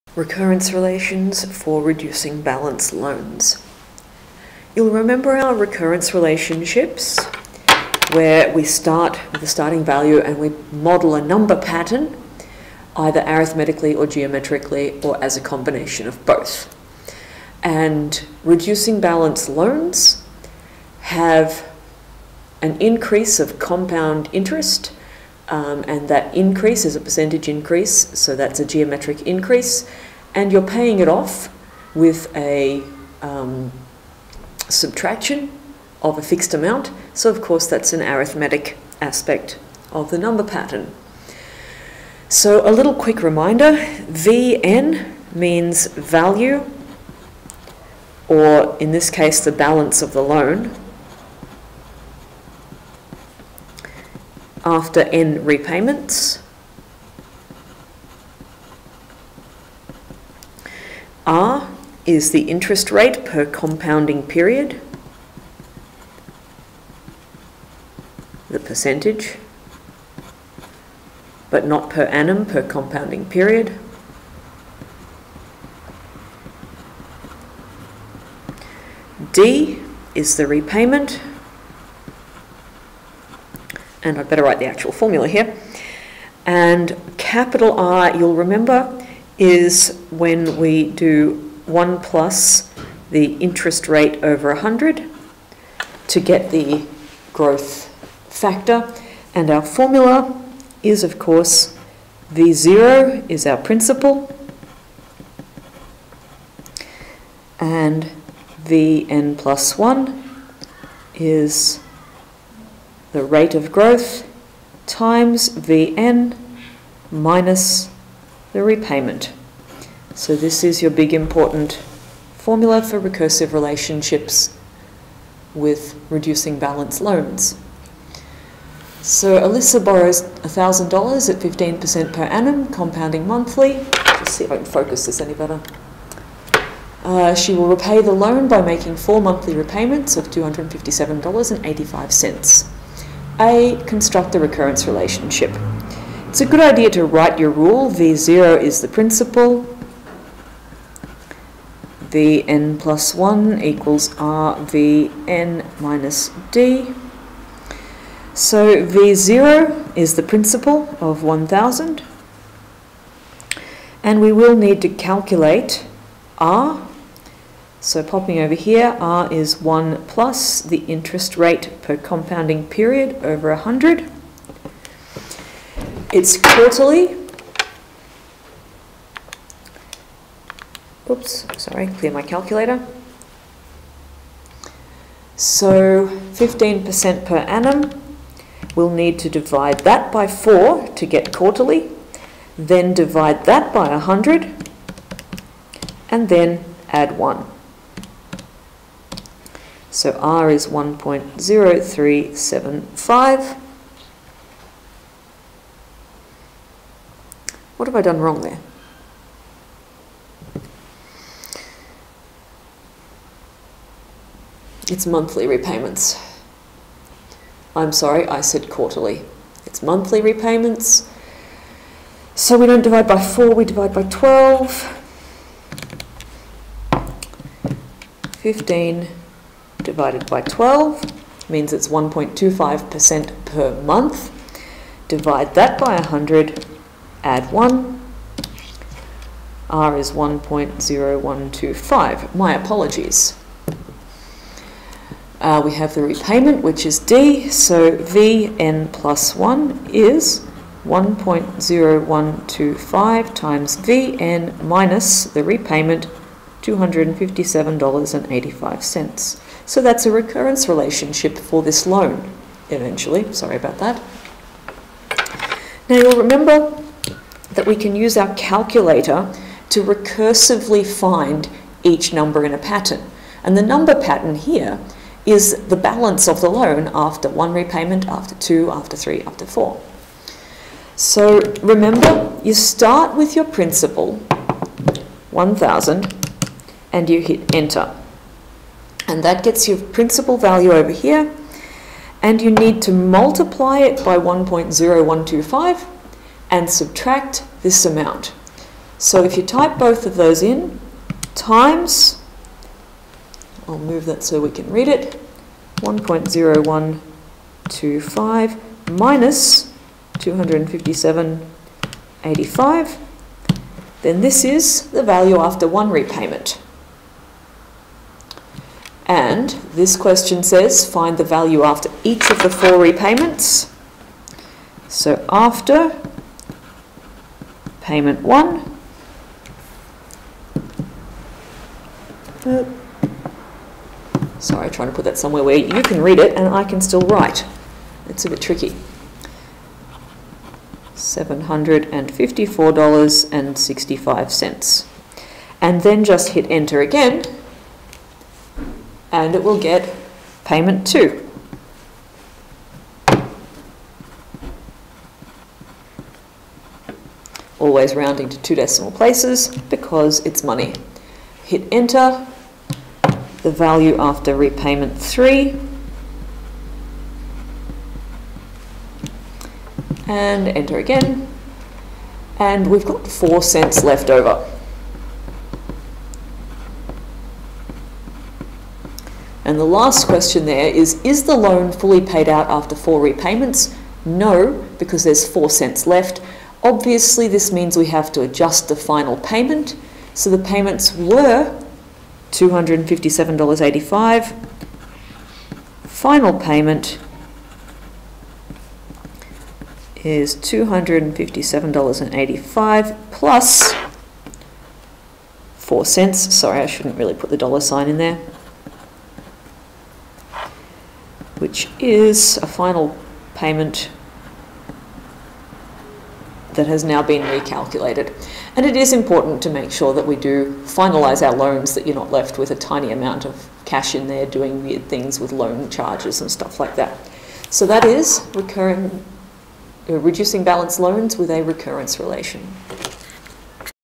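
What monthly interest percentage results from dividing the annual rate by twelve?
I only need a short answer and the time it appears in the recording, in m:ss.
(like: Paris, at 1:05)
1.25%, at 3:51.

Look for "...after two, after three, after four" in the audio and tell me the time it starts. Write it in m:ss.
4:38.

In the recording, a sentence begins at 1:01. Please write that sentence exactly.
R is the interest rate per compounding period, the percentage, but not per annum per compounding period.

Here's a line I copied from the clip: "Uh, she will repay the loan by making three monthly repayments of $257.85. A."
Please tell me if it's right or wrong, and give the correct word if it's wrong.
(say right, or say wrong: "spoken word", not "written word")
wrong: "four", not "three".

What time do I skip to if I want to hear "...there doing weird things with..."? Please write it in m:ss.
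7:04.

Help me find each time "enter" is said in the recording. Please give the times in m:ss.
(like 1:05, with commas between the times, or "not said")
4:47, 5:46, 6:01, 6:10.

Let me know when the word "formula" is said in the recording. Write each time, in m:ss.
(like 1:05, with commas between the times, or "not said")
1:24, 1:39, 2:02.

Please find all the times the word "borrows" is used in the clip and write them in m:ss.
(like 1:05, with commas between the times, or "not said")
2:09.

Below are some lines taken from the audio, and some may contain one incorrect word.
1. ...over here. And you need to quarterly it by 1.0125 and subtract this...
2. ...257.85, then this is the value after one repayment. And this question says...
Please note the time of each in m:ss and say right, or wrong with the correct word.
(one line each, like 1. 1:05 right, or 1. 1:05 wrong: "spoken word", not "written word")
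1. 4:50 wrong: "multiply", not "quarterly"
2. 5:10 right.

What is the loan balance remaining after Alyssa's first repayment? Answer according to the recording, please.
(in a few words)
$754.65.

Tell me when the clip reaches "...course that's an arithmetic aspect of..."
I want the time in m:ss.
0:37.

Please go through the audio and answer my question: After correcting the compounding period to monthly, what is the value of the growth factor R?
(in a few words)
1.0125.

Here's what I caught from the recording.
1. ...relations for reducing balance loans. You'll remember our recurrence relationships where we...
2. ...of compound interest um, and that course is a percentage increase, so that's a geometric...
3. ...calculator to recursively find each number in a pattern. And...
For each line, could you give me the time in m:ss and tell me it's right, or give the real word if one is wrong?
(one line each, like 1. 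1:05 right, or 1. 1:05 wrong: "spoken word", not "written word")
1. 0:00 right
2. 0:23 wrong: "increase", not "course"
3. 4:28 right.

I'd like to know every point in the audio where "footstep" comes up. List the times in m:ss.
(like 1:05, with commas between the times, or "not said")
not said.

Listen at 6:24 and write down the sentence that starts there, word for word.
No, because there's four cents left.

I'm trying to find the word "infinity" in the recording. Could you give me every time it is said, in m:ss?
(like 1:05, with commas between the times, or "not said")
not said.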